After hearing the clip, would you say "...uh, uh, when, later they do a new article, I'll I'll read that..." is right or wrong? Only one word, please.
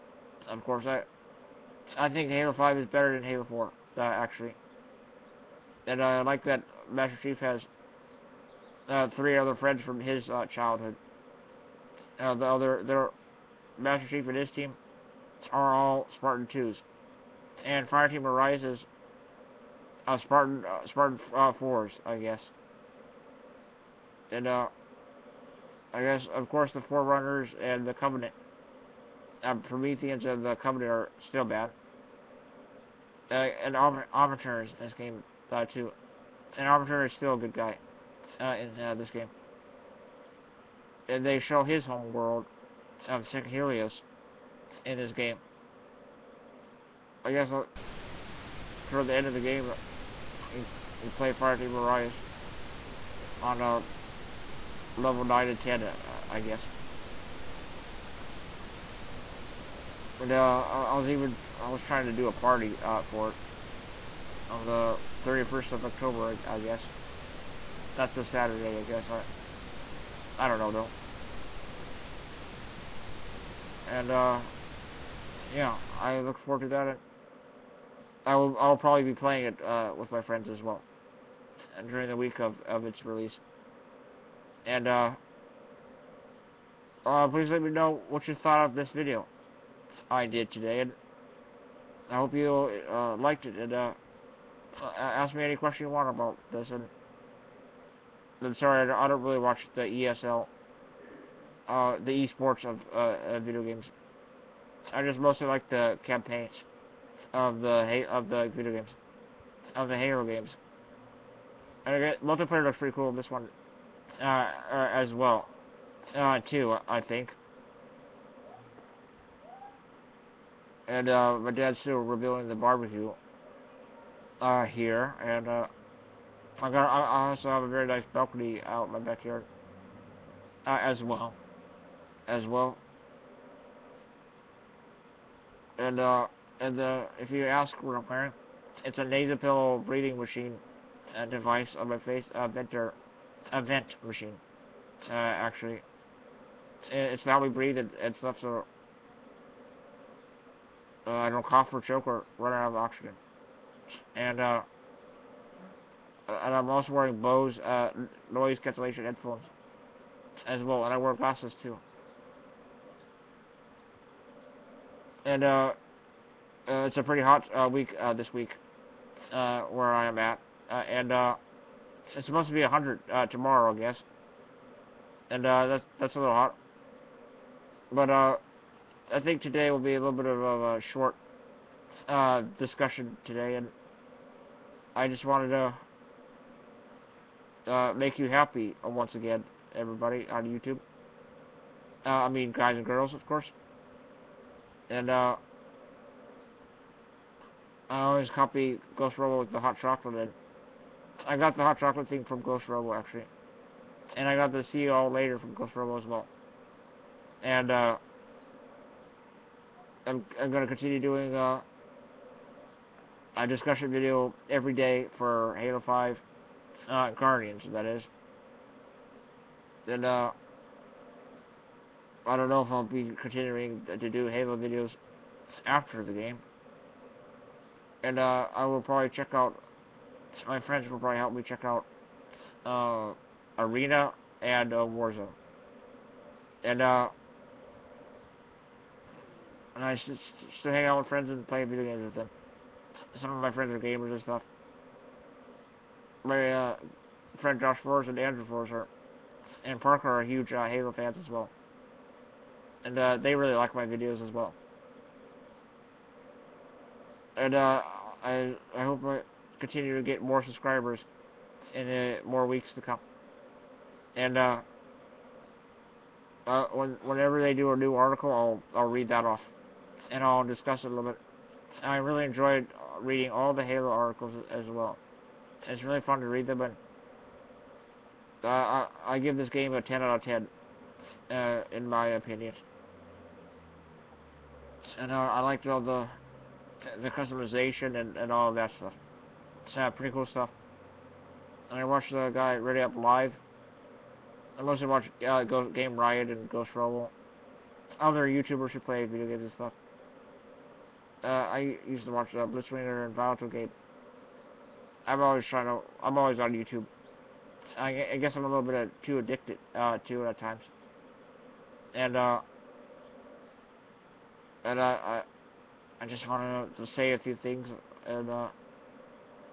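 wrong.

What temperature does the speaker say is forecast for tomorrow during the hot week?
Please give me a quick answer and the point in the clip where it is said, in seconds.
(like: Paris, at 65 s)
100, at 172 s.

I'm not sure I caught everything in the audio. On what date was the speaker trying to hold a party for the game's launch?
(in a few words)
31st of October.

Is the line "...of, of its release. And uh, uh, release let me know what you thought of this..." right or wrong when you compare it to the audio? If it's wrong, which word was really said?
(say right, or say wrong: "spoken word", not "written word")
wrong: "please", not "release".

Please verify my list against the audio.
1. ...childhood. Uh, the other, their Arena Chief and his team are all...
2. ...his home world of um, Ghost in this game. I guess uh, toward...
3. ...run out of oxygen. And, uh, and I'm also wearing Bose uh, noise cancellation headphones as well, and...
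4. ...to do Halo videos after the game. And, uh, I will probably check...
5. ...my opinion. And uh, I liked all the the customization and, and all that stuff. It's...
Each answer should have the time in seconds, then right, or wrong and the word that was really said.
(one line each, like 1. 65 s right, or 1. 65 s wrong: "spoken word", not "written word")
1. 10 s wrong: "Master", not "Arena"
2. 41 s wrong: "Helios", not "Ghost"
3. 152 s right
4. 223 s right
5. 281 s right.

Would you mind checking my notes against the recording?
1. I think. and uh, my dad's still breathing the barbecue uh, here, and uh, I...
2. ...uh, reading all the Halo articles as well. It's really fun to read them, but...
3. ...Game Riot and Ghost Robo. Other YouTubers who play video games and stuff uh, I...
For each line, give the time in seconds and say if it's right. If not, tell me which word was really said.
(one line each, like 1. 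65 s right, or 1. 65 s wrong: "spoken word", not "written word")
1. 116 s wrong: "rebuilding", not "breathing"
2. 272 s right
3. 295 s right.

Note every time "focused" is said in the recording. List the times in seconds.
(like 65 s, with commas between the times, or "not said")
not said.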